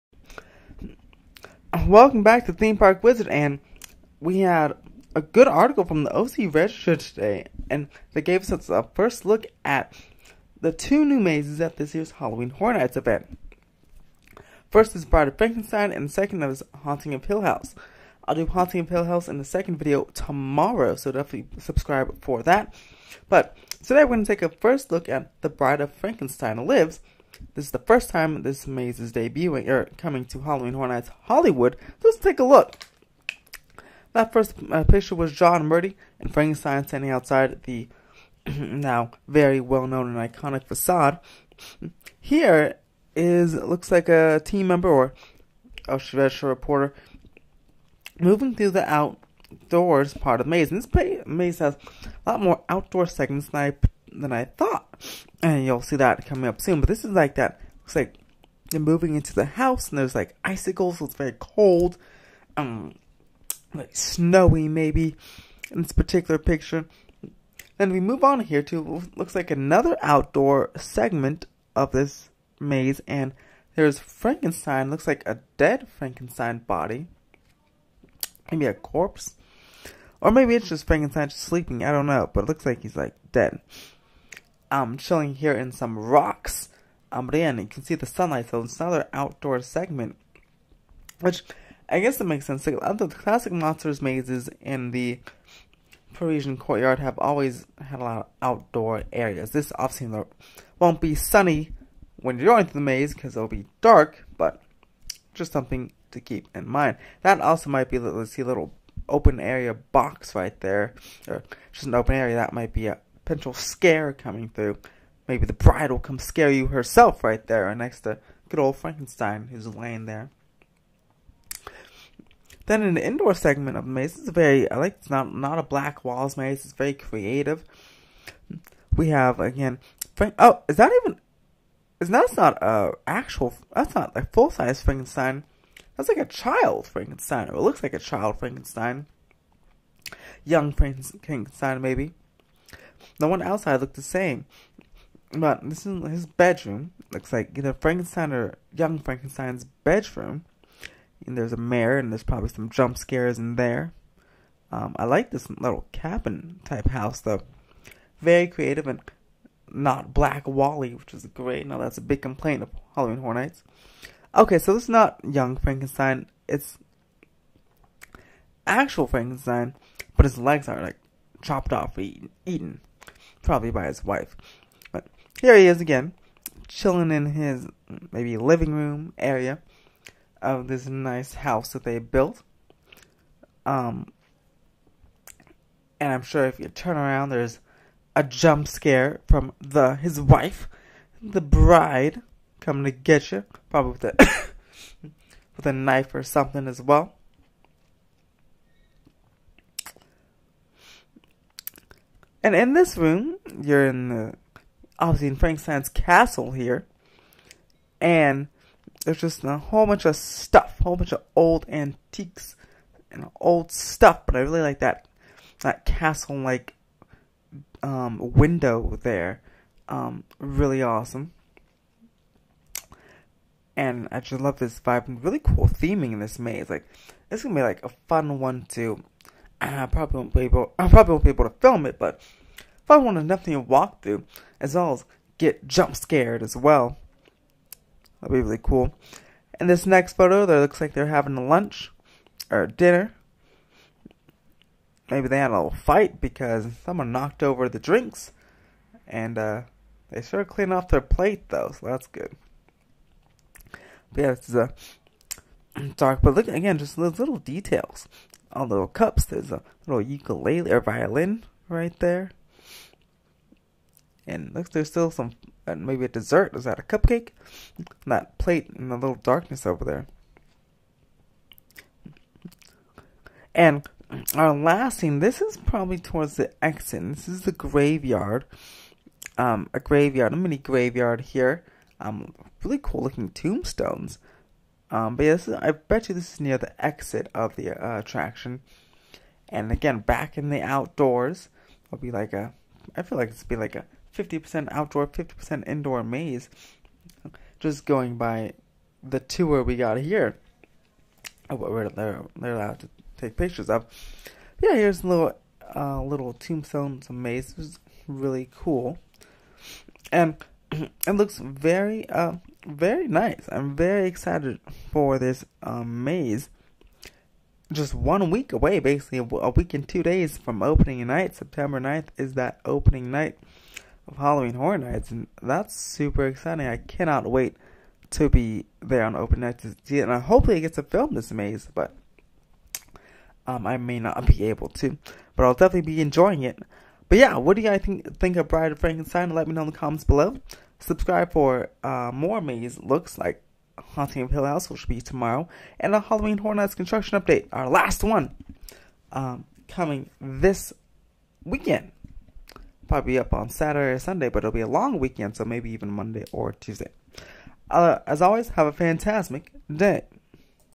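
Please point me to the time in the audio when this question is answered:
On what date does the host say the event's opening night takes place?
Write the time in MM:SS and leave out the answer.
05:21.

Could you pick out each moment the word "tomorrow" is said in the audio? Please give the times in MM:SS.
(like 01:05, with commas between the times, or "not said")
00:20, 05:45.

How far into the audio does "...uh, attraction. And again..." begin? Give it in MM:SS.
04:47.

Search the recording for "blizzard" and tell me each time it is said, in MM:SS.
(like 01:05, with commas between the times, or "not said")
not said.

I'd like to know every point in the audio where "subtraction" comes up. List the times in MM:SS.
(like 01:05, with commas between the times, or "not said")
not said.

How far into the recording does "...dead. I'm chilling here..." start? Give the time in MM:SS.
01:23.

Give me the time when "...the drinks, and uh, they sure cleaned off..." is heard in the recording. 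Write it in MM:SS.
04:07.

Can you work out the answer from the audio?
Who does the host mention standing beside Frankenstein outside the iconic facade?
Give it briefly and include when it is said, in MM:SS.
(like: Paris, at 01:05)
John Murdy, at 00:35.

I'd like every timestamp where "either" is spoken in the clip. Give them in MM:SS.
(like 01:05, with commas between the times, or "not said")
02:27.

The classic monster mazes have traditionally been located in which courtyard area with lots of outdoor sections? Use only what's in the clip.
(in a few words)
Parisian courtyard.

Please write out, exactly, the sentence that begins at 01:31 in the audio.
Which, I guess it makes sense.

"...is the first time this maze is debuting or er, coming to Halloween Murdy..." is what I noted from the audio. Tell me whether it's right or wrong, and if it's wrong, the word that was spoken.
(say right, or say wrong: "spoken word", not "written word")
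wrong: "Horror", not "Murdy".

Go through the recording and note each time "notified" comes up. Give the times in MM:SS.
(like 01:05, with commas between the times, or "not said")
not said.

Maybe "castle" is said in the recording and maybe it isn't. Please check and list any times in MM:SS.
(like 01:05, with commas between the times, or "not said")
03:25, 03:35.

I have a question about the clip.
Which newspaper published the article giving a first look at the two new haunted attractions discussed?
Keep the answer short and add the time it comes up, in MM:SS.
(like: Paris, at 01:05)
OC Register, at 00:06.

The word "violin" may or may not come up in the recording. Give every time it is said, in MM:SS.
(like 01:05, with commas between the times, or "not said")
04:20.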